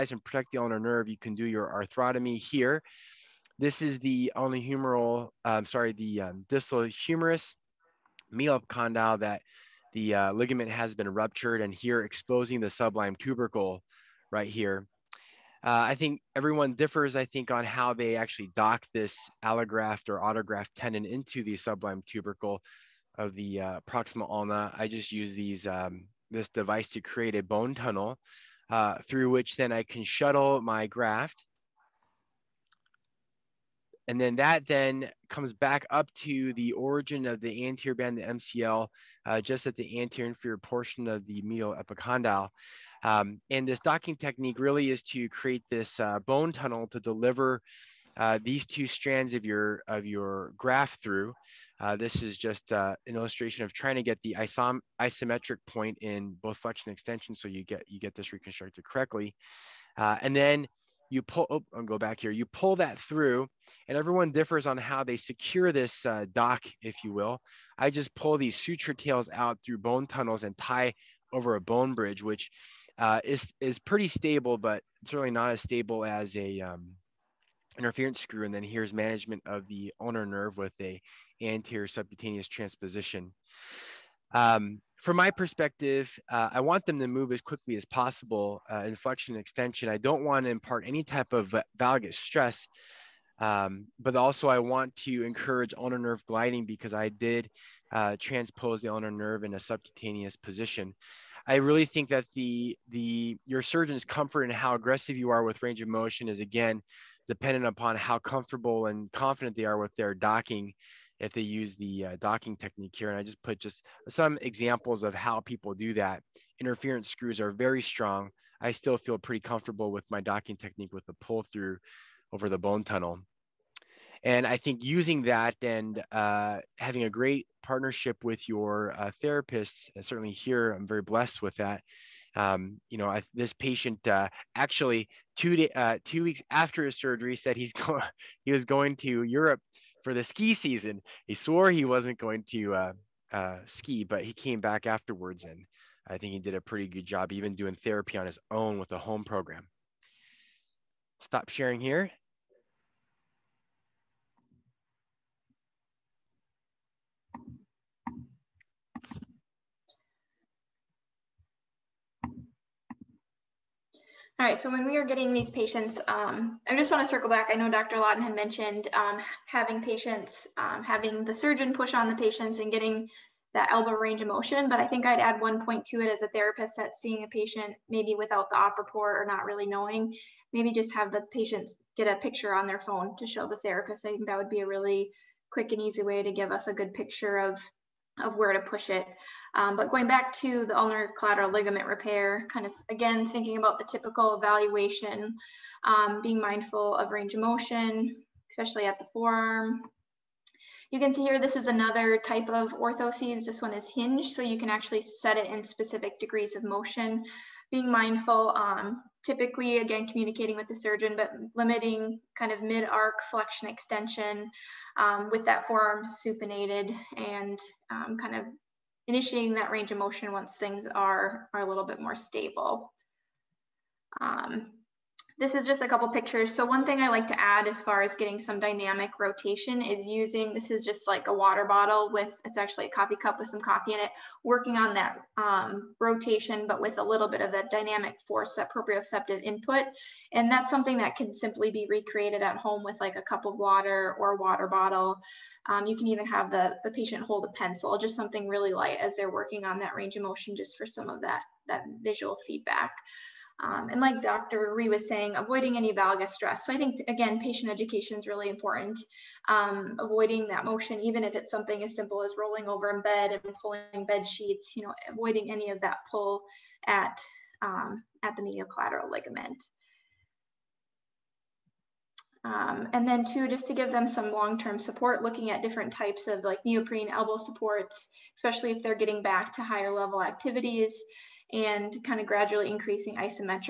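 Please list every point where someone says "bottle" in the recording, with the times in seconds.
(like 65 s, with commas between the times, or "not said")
231 s, 244 s.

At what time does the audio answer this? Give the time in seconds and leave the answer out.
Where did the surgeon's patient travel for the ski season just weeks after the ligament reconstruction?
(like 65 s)
139 s.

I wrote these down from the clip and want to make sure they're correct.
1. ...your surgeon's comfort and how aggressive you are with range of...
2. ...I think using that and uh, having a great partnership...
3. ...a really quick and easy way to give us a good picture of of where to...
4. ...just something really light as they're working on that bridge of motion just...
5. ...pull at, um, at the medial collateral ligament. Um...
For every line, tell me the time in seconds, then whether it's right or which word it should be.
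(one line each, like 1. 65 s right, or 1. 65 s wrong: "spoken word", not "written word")
1. 103 s right
2. 124 s right
3. 184 s right
4. 247 s wrong: "range", not "bridge"
5. 266 s right.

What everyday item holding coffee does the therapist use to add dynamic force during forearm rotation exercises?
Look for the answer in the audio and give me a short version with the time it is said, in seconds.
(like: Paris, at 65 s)
Coffee cup, at 232 s.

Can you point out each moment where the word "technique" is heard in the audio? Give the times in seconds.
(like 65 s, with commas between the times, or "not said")
44 s, 112 s, 120 s.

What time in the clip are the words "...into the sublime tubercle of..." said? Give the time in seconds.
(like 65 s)
21 s.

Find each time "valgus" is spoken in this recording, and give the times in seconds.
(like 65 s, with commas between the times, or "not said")
91 s, 255 s.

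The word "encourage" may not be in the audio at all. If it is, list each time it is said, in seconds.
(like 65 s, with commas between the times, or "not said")
95 s.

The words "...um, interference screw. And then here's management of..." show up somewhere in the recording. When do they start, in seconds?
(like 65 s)
76 s.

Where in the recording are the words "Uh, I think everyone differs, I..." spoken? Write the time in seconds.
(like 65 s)
15 s.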